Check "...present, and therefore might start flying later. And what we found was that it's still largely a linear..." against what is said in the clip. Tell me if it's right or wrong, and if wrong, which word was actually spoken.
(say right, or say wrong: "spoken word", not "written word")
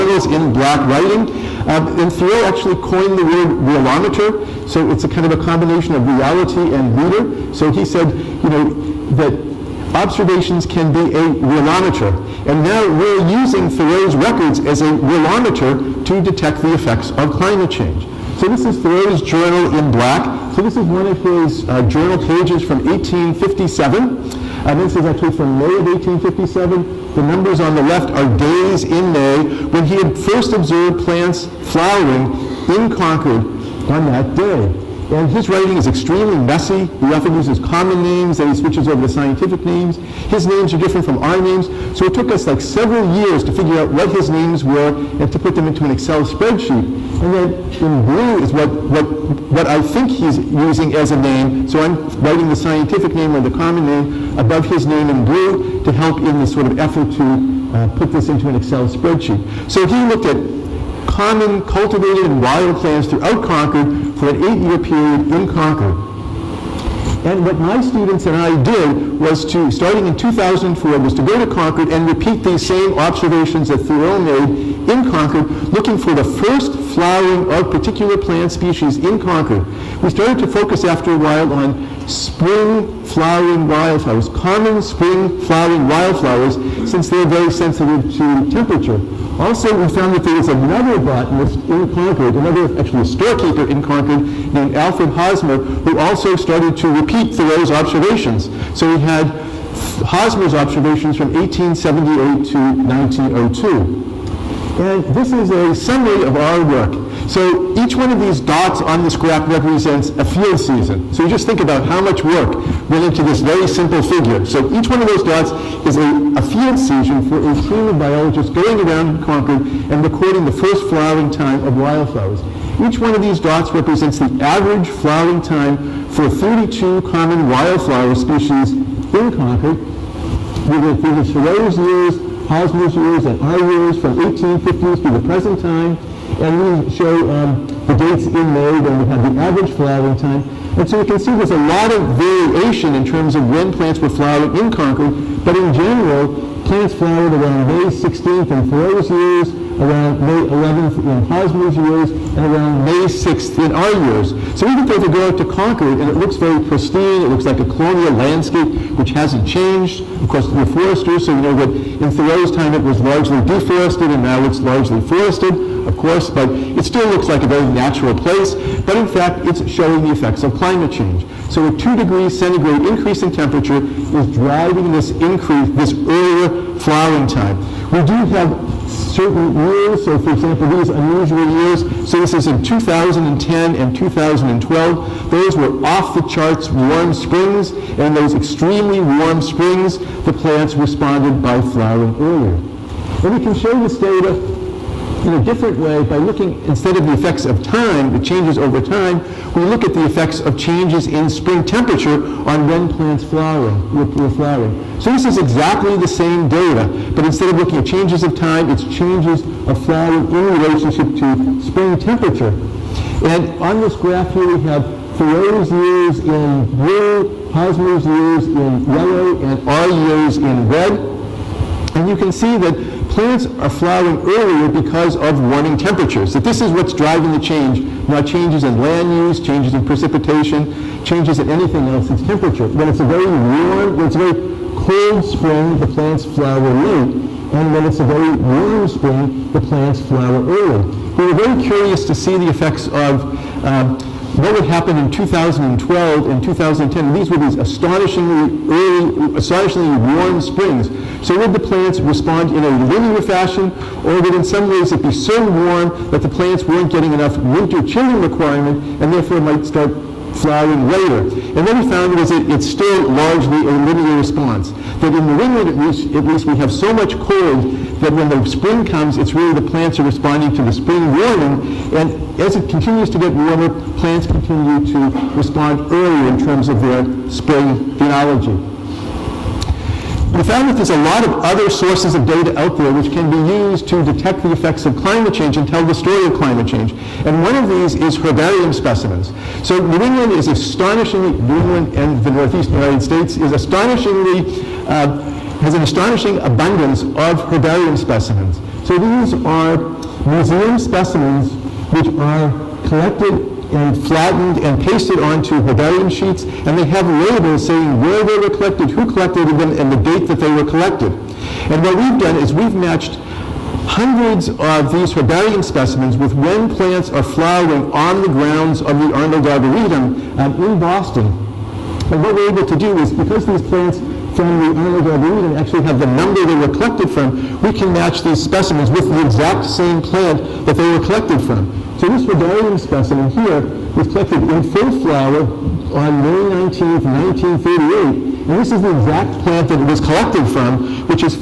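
wrong: "requirement", not "present".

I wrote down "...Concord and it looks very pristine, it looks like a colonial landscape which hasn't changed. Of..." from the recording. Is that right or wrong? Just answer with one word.
right.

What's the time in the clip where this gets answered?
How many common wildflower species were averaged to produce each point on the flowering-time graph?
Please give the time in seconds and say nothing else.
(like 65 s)
126 s.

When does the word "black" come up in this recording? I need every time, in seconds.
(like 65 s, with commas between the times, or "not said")
0 s, 19 s.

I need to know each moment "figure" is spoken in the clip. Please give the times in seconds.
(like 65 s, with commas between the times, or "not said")
43 s, 114 s.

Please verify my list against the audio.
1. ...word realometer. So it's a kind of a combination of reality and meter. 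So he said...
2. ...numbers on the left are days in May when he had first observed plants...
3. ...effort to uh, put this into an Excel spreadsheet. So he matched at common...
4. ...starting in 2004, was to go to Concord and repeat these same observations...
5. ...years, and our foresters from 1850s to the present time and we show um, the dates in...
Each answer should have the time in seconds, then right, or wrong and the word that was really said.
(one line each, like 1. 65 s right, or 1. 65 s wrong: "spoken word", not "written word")
1. 3 s right
2. 27 s right
3. 56 s wrong: "looked", not "matched"
4. 69 s right
5. 132 s wrong: "years", not "foresters".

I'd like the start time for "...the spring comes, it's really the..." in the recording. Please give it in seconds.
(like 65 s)
268 s.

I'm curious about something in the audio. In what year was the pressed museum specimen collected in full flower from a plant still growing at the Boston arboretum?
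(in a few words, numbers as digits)
1938.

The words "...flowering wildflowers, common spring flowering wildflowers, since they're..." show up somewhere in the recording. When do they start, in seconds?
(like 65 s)
83 s.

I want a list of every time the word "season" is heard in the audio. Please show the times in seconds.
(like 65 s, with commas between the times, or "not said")
110 s, 116 s.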